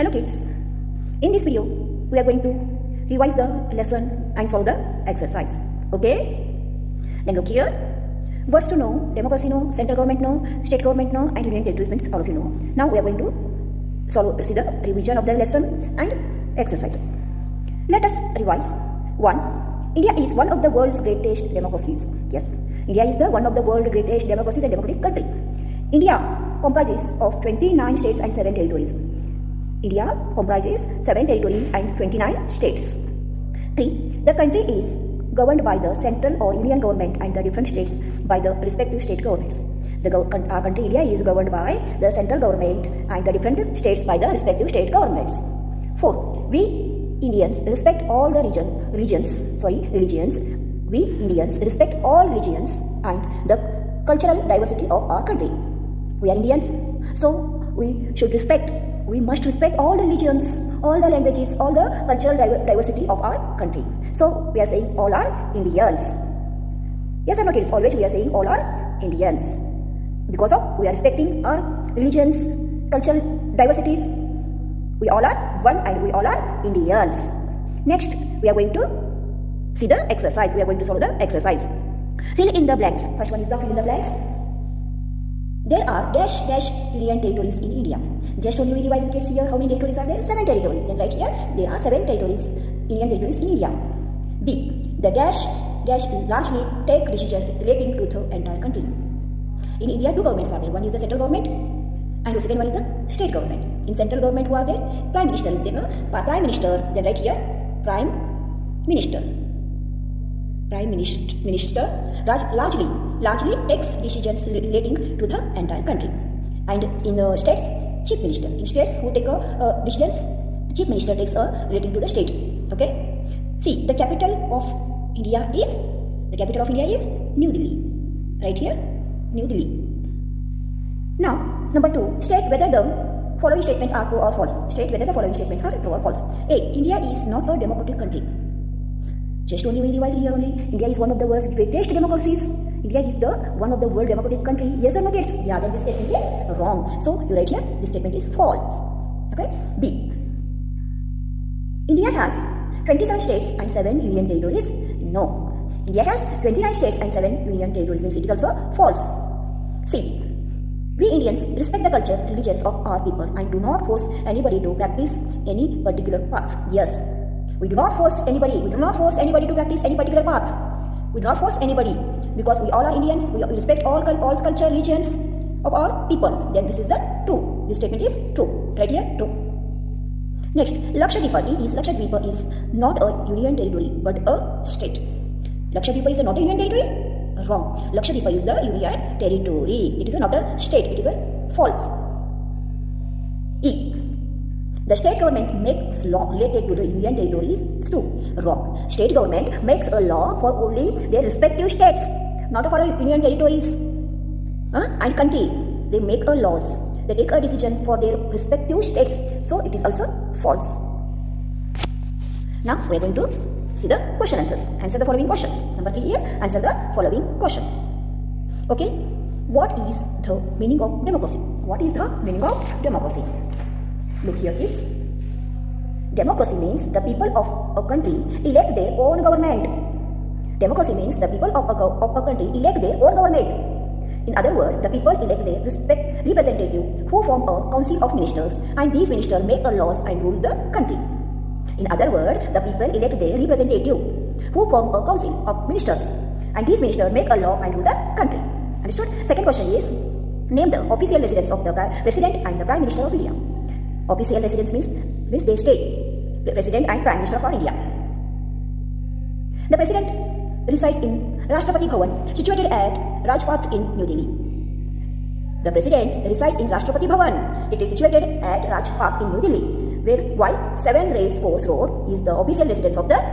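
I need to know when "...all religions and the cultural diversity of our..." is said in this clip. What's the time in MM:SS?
00:52.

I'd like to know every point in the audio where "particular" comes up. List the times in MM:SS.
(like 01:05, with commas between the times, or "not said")
02:45, 02:49.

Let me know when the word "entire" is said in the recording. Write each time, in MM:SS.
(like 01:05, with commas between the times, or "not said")
01:38, 01:55.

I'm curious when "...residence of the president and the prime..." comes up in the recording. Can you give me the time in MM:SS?
04:11.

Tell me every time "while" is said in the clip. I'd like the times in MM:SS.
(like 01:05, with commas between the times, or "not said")
04:30.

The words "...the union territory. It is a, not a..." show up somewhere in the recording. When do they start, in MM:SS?
03:08.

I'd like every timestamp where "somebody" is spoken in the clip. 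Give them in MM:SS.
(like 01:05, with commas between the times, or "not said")
not said.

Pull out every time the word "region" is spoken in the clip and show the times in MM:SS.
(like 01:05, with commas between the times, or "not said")
00:48.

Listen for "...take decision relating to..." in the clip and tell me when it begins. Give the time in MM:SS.
01:36.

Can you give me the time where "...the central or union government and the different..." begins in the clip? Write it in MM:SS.
00:35.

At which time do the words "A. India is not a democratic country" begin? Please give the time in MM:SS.
02:16.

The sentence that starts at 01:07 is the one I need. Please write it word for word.
Always we are saying all are Indians.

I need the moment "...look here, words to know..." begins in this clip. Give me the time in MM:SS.
00:07.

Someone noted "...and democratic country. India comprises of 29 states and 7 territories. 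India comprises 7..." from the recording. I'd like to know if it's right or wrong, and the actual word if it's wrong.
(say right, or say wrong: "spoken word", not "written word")
right.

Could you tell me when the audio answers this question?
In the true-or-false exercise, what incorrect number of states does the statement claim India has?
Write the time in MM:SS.
02:32.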